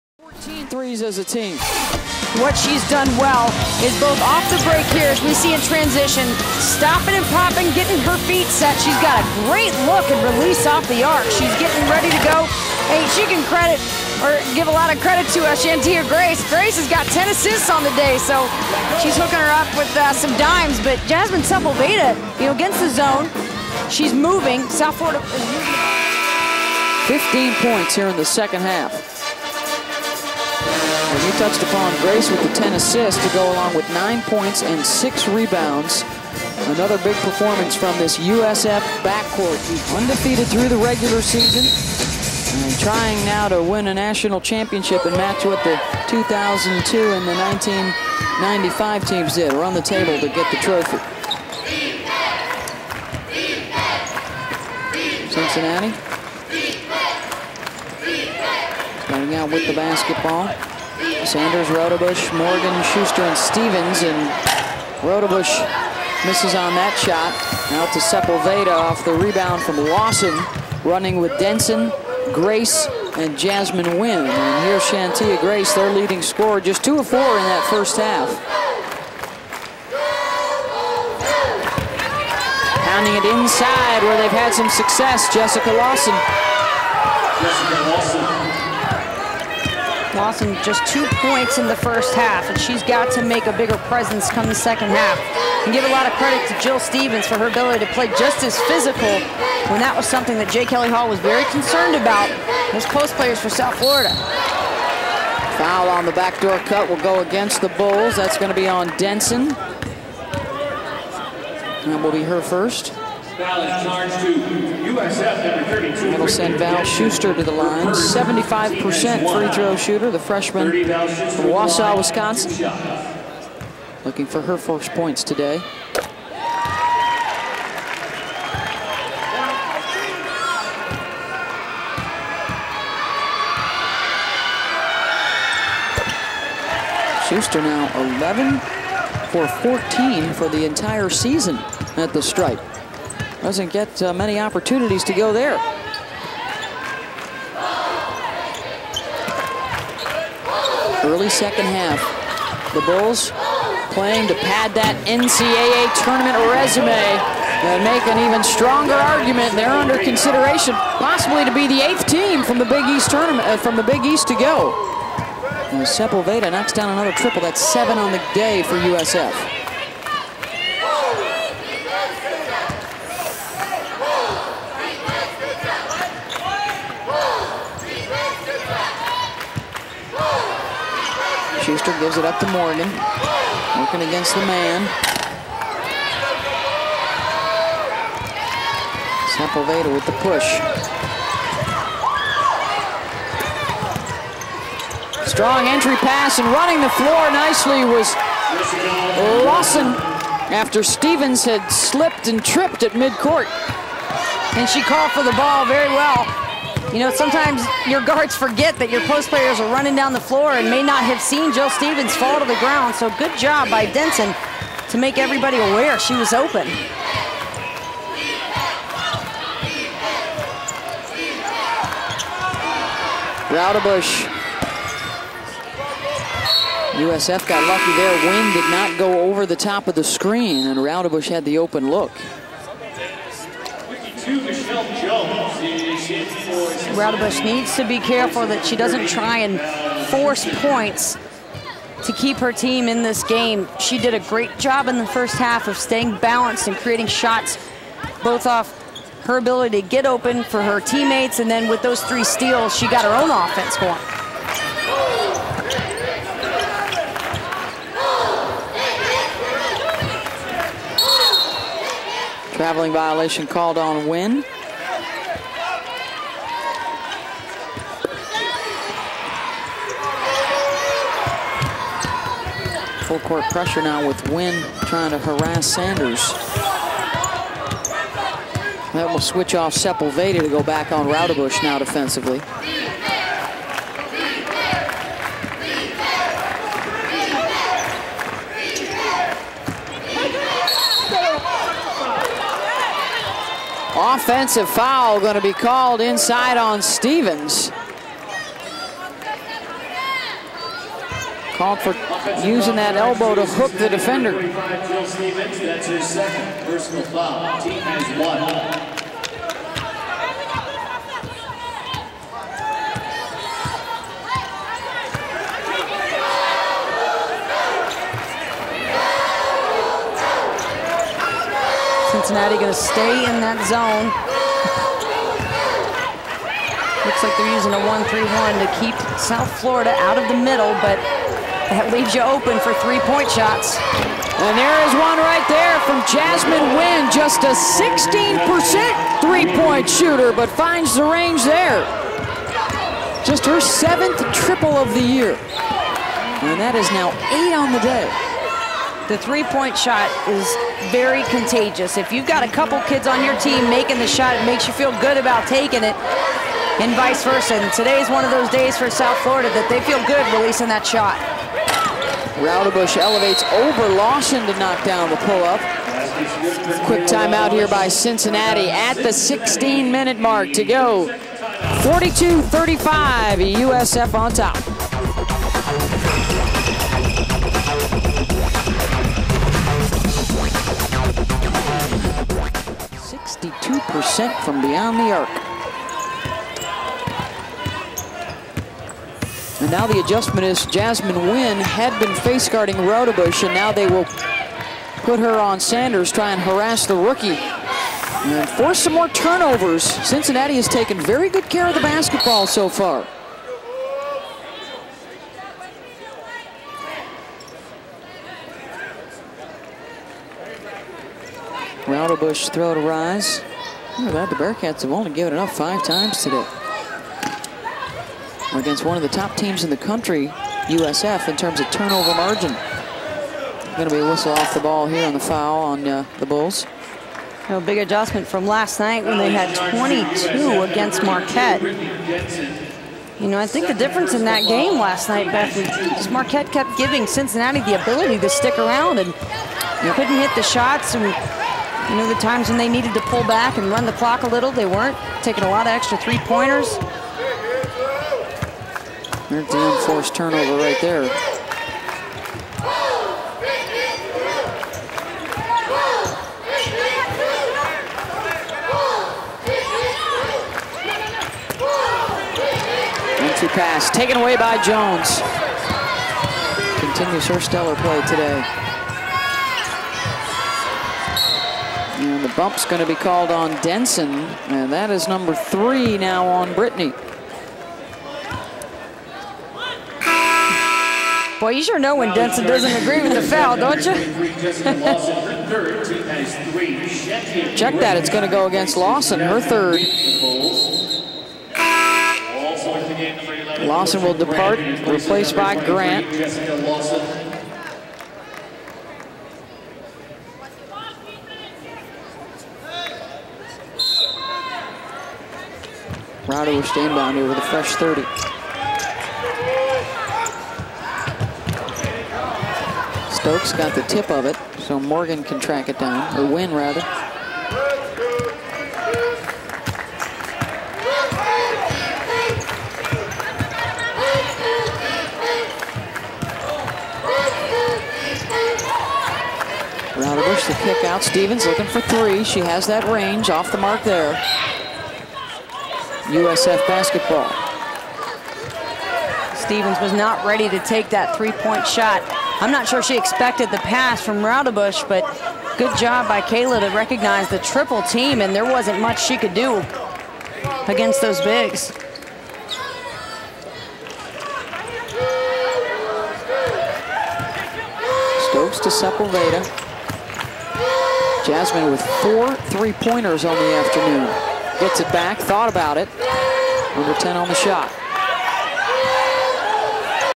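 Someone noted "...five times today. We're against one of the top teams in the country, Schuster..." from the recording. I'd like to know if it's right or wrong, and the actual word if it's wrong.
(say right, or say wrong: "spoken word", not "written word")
wrong: "USF", not "Schuster".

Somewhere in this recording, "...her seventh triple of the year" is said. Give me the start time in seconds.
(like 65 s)
343 s.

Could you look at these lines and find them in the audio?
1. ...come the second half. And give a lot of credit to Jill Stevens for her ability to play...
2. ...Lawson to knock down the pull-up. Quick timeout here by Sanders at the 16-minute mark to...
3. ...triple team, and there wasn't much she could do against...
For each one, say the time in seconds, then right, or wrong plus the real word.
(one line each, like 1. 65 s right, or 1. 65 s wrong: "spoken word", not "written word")
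1. 94 s right
2. 363 s wrong: "Cincinnati", not "Sanders"
3. 547 s right.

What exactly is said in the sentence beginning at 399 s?
Cincinnati has taken very good care of the basketball so far.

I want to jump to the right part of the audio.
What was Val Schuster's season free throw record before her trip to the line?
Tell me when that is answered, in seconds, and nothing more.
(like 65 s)
138 s.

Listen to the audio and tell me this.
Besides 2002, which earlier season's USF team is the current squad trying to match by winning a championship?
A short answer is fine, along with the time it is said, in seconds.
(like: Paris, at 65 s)
1995, at 47 s.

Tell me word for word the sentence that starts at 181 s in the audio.
Schuster gives it up to Morgan.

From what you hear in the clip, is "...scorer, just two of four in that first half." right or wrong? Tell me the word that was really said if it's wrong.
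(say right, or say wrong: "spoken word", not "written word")
right.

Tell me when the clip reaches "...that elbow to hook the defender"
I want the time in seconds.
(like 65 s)
302 s.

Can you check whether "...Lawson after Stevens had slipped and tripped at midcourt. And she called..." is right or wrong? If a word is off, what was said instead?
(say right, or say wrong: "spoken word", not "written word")
right.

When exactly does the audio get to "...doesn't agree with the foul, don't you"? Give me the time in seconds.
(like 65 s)
482 s.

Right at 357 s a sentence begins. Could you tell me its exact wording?
And is one of those days for South Florida that they feel good releasing that shot.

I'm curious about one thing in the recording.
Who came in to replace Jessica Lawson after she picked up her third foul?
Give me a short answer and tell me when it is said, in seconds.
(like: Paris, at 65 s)
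Grant, at 495 s.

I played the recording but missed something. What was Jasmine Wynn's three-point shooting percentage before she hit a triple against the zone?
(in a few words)
16%.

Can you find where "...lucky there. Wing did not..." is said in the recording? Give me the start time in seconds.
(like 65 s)
227 s.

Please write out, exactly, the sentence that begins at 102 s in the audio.
as post players for South Florida.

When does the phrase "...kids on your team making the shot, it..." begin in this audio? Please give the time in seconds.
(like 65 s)
352 s.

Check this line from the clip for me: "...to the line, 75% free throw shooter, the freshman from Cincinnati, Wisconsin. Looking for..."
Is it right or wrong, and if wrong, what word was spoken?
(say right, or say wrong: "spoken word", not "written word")
wrong: "Wausau", not "Cincinnati".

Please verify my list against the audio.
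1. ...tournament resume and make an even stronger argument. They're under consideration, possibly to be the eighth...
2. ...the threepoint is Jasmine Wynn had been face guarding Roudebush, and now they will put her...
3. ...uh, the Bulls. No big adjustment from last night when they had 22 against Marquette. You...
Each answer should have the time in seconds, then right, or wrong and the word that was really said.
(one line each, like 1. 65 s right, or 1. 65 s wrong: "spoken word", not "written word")
1. 156 s right
2. 389 s wrong: "adjustment", not "threepoint"
3. 425 s right.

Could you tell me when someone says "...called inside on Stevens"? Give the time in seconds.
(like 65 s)
295 s.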